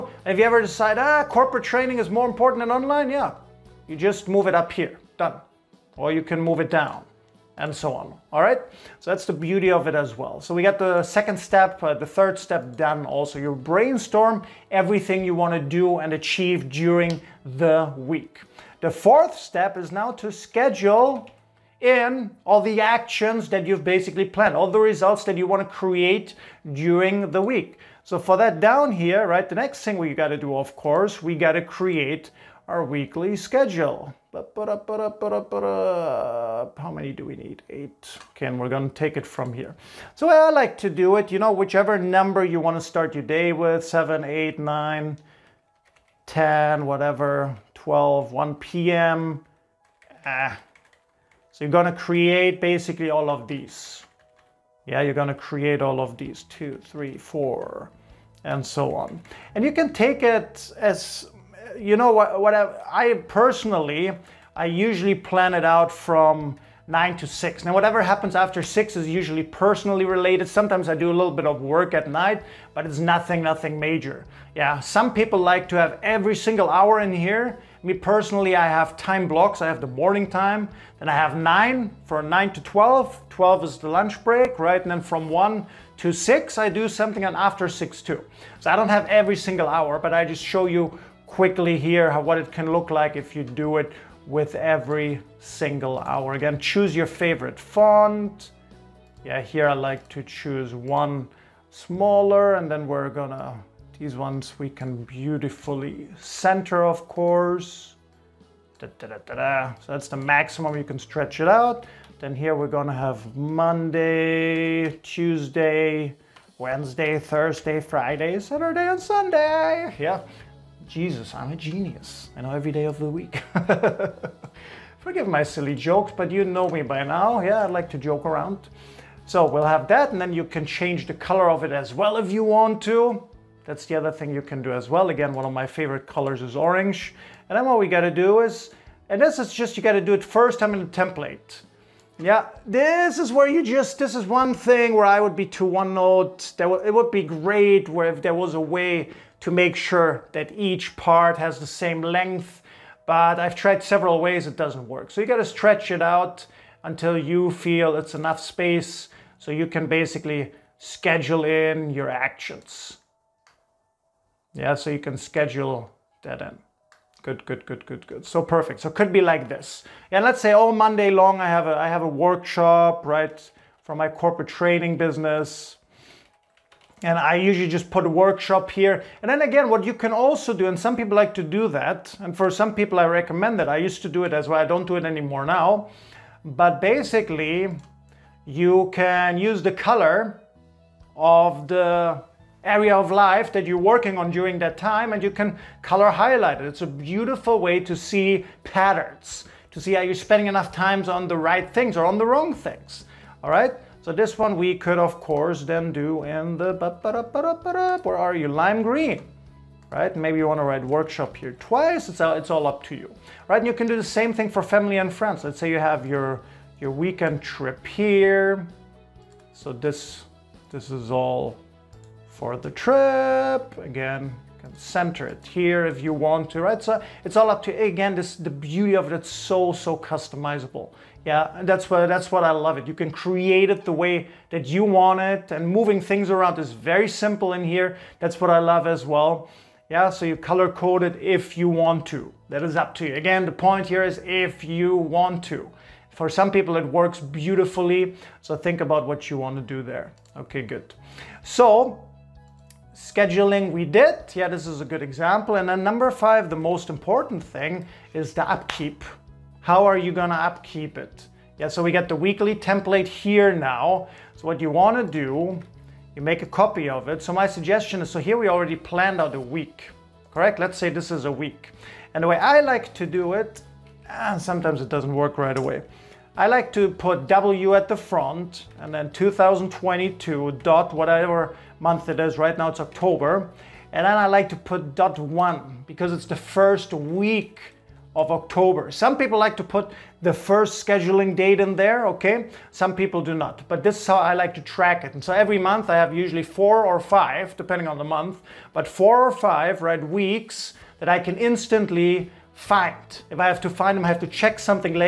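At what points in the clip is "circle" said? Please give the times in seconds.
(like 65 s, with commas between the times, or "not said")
not said.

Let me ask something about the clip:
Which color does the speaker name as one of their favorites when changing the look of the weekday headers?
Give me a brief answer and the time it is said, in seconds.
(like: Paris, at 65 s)
Orange, at 136 s.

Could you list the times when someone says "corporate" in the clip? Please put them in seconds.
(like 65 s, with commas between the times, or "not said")
1 s, 174 s.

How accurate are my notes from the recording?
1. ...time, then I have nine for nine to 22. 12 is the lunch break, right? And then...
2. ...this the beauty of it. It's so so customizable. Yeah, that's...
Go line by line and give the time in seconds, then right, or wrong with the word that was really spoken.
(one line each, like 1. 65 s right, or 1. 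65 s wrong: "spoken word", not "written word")
1. 80 s wrong: "12", not "22"
2. 228 s right.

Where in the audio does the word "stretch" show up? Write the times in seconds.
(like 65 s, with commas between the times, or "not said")
111 s, 155 s.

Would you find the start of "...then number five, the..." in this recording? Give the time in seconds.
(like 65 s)
255 s.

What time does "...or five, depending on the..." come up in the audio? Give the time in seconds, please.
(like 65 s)
296 s.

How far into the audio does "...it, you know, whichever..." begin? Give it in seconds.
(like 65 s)
41 s.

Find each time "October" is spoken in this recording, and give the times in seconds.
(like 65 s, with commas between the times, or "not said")
282 s, 288 s.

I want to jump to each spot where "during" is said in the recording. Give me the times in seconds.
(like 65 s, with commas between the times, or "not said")
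16 s, 26 s, 194 s.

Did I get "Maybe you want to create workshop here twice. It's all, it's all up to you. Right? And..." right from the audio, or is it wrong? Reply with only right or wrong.
wrong.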